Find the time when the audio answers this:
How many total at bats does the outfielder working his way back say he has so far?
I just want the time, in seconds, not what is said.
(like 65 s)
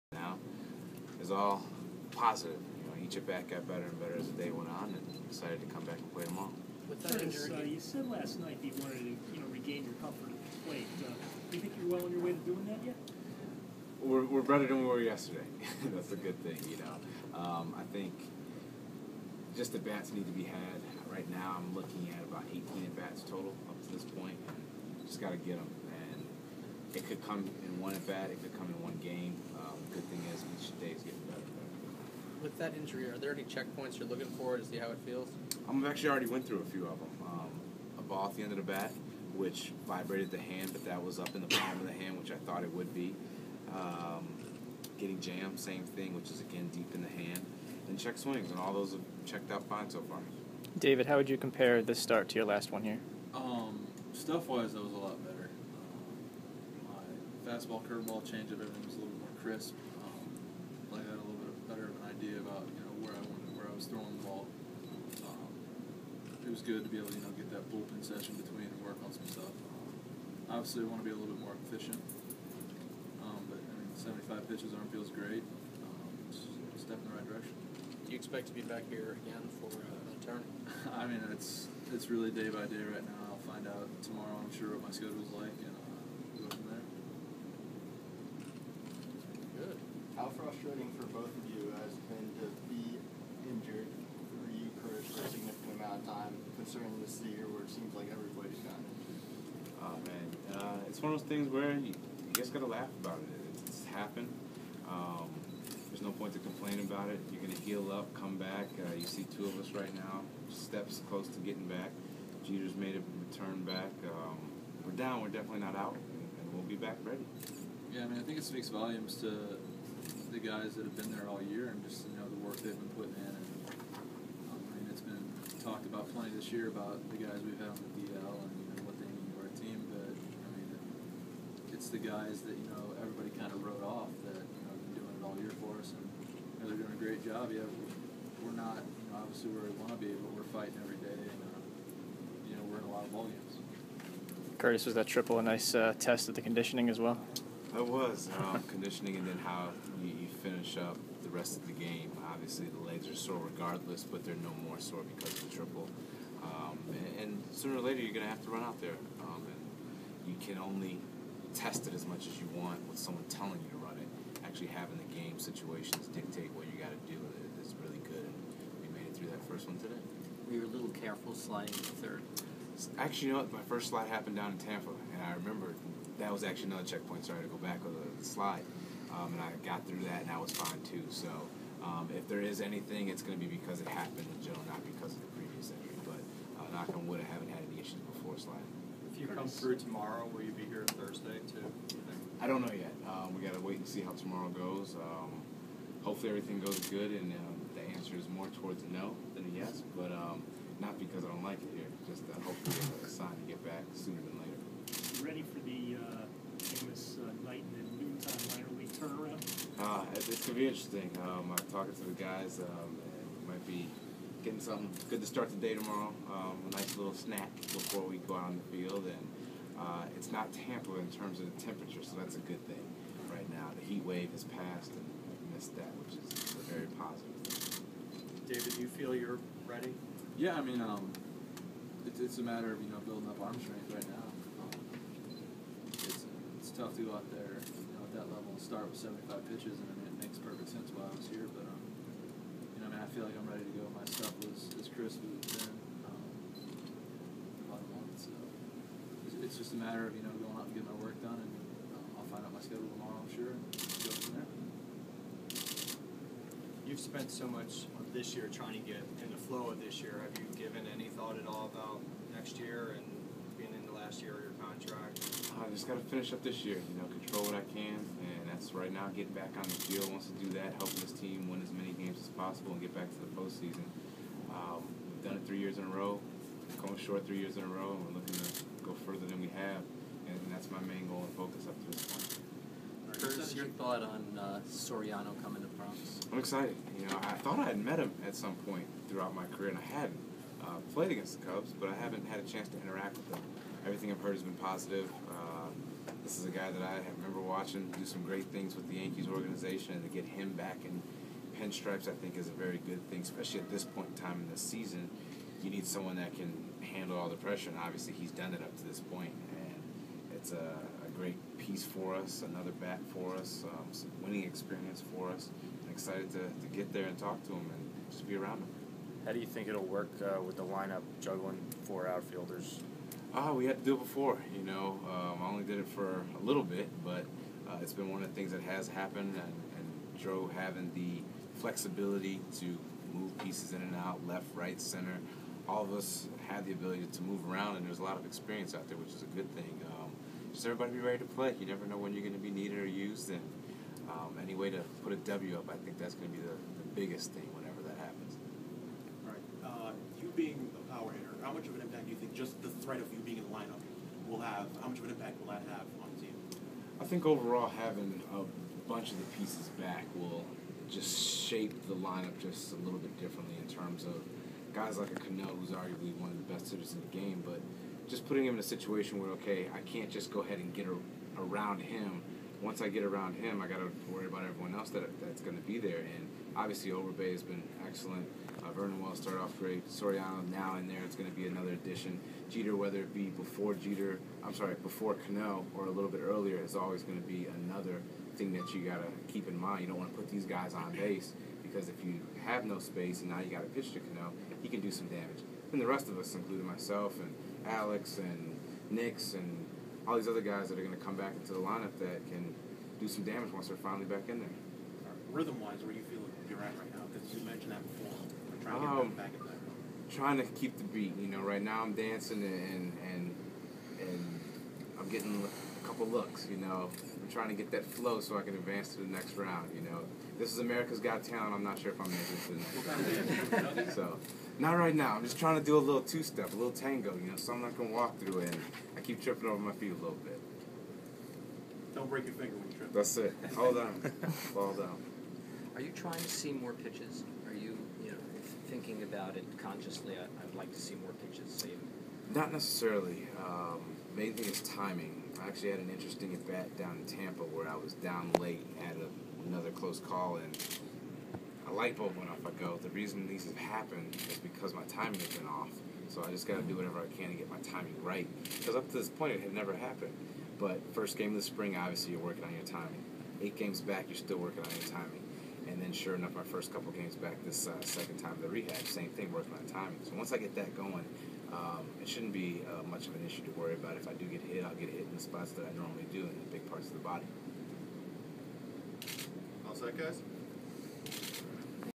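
22 s.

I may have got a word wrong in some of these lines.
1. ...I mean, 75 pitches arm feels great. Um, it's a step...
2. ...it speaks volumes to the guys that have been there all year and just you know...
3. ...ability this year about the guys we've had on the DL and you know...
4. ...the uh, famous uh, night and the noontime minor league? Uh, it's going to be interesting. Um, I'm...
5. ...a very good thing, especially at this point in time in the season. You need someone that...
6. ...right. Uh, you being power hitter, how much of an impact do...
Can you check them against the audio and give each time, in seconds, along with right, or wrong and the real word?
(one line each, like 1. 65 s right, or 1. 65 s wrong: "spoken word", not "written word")
1. 73 s right
2. 118 s right
3. 126 s wrong: "plenty", not "ability"
4. 205 s right
5. 302 s right
6. 349 s right.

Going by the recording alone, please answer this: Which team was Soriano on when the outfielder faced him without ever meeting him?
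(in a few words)
Cubs.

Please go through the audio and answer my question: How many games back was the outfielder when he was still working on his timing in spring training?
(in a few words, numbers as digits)
8.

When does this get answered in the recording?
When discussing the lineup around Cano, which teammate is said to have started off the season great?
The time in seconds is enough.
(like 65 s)
378 s.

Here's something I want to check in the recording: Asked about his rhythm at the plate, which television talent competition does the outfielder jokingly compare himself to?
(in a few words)
America's Got Talent.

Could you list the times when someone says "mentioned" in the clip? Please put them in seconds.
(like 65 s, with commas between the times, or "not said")
407 s.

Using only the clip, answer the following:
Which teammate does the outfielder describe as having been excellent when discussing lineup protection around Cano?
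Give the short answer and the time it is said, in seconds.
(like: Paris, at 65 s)
Overbay, at 376 s.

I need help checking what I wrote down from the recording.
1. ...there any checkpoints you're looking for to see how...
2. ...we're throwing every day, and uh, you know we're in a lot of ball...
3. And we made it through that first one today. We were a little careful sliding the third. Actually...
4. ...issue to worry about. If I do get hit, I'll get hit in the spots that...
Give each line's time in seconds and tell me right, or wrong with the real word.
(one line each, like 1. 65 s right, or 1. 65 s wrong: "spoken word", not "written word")
1. 33 s right
2. 140 s wrong: "fighting", not "throwing"
3. 168 s right
4. 473 s right.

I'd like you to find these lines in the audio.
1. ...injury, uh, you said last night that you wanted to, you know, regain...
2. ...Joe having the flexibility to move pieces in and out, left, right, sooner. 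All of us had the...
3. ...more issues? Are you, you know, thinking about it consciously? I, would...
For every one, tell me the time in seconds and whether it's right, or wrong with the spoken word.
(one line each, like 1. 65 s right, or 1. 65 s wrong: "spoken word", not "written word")
1. 7 s right
2. 330 s wrong: "center", not "sooner"
3. 436 s wrong: "pitches", not "issues".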